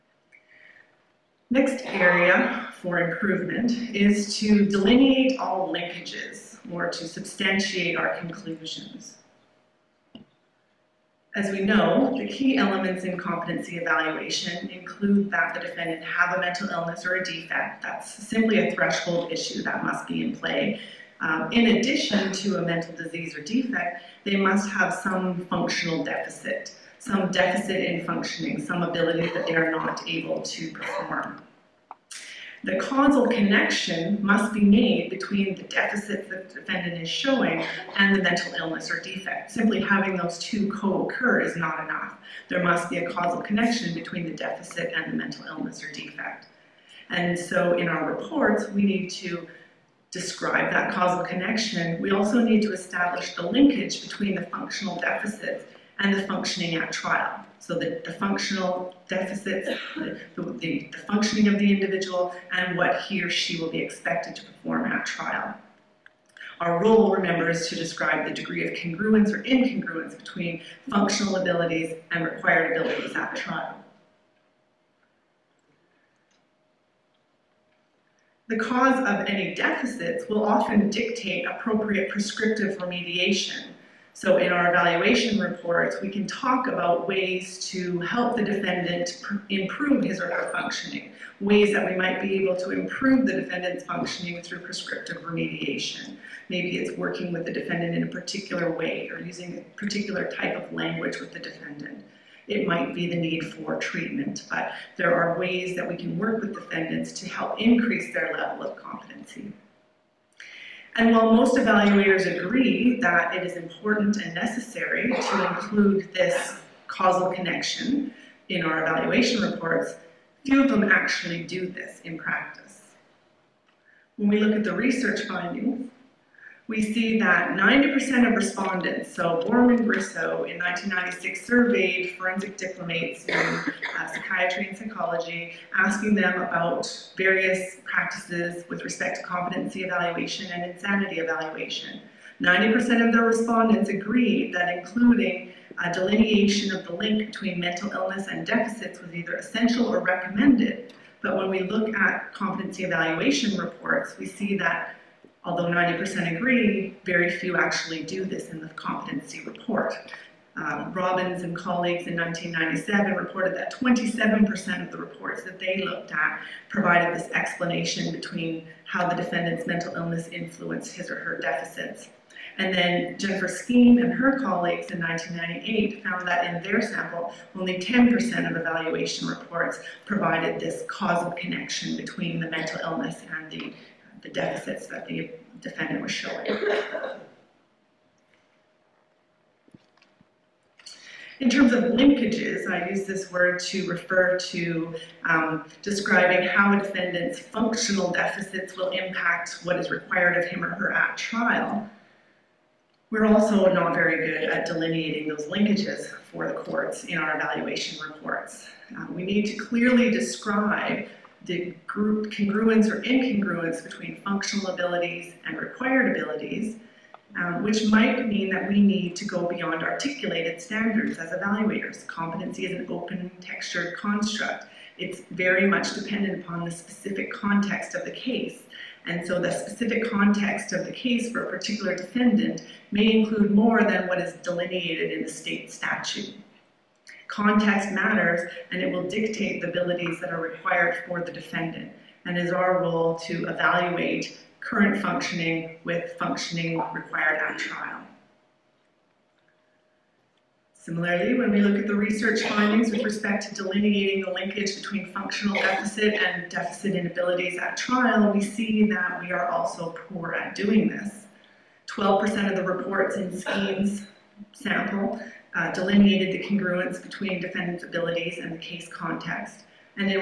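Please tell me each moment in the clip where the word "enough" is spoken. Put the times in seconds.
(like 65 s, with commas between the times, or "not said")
41 s.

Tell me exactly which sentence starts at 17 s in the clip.
That's simply a threshold issue that must be in play.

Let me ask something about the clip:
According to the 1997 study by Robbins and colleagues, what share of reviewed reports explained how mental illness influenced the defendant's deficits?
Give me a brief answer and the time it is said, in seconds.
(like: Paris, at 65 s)
27%, at 163 s.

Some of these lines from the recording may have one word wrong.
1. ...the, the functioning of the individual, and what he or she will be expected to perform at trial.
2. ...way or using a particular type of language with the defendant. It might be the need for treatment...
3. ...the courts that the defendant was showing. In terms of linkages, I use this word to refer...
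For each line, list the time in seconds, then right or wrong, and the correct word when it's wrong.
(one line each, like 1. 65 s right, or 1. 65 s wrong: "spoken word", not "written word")
1. 60 s right
2. 98 s right
3. 184 s wrong: "deficits", not "courts".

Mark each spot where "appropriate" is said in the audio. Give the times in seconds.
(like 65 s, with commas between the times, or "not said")
81 s.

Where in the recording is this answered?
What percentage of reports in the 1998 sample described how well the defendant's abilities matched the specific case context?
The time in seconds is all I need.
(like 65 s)
261 s.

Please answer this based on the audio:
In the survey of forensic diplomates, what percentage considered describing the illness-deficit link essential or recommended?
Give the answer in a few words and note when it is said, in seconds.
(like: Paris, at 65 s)
90%, at 142 s.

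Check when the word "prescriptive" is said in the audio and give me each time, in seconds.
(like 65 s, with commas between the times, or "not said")
82 s, 94 s.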